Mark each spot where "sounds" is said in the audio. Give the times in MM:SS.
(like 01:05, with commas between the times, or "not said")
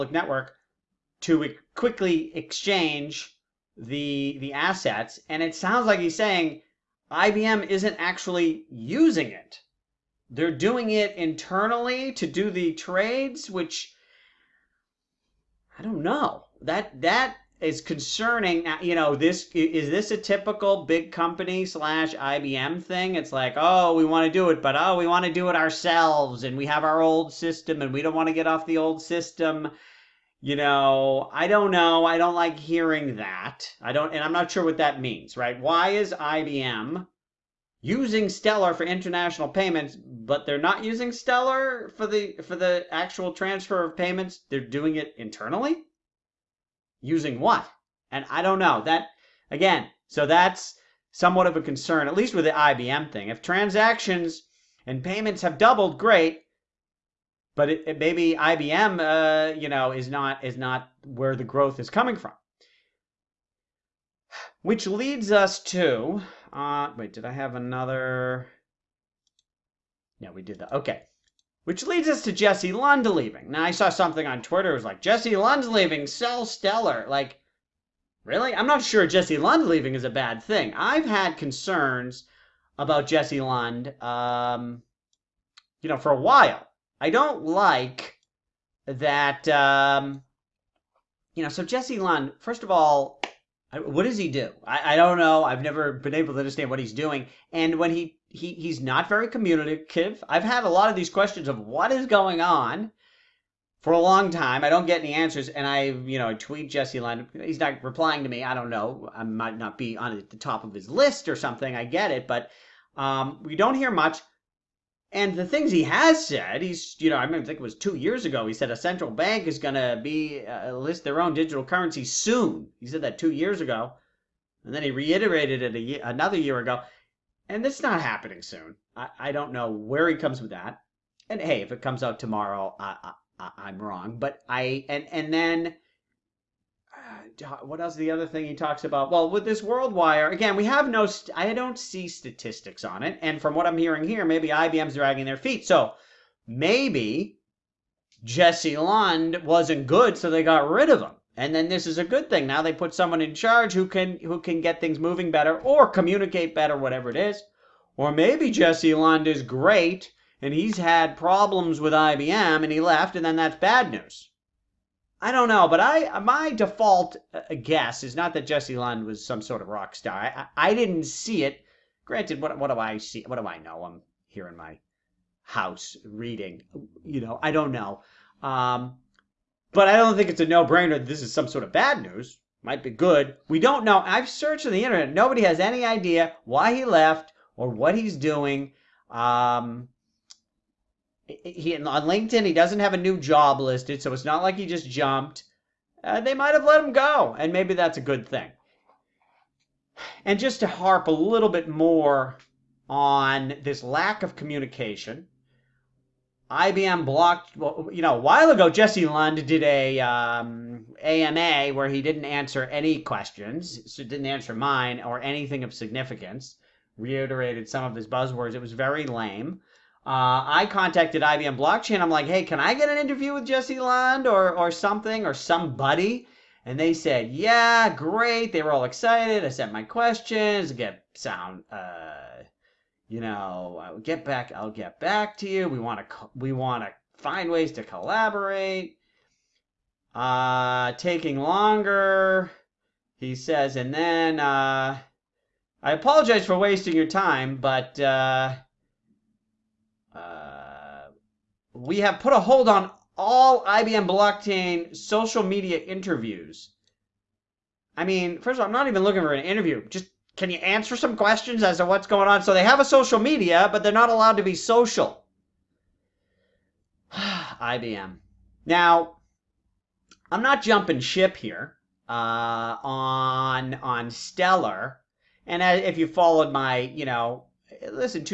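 00:05, 03:51.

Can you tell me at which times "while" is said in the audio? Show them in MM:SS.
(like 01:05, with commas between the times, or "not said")
01:26, 03:28.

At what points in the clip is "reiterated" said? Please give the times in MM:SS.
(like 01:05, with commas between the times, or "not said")
02:04, 03:36.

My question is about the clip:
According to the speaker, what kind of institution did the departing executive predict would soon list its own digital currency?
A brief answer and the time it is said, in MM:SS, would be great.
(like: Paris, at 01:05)
A central bank, at 01:58.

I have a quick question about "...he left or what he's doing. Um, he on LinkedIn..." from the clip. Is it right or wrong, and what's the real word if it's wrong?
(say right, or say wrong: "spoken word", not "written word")
right.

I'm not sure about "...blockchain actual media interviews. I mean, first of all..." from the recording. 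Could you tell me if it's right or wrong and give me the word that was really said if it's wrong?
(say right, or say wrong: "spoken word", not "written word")
wrong: "social", not "actual".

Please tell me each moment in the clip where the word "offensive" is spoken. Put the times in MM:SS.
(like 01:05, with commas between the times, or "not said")
not said.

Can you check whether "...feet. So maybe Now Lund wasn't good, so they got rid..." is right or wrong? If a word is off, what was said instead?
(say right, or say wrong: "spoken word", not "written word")
wrong: "Jesse", not "Now".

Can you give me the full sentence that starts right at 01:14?
It was like, Jesse Lund's leaving, sell Stellar.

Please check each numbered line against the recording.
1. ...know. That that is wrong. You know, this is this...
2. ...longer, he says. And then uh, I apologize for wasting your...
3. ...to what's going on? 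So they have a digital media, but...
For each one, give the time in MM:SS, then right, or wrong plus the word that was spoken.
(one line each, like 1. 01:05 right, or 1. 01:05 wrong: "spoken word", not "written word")
1. 00:16 wrong: "concerning", not "wrong"
2. 04:01 right
3. 04:21 wrong: "social", not "digital".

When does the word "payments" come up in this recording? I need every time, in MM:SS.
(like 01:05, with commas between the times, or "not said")
00:39, 00:43, 00:55.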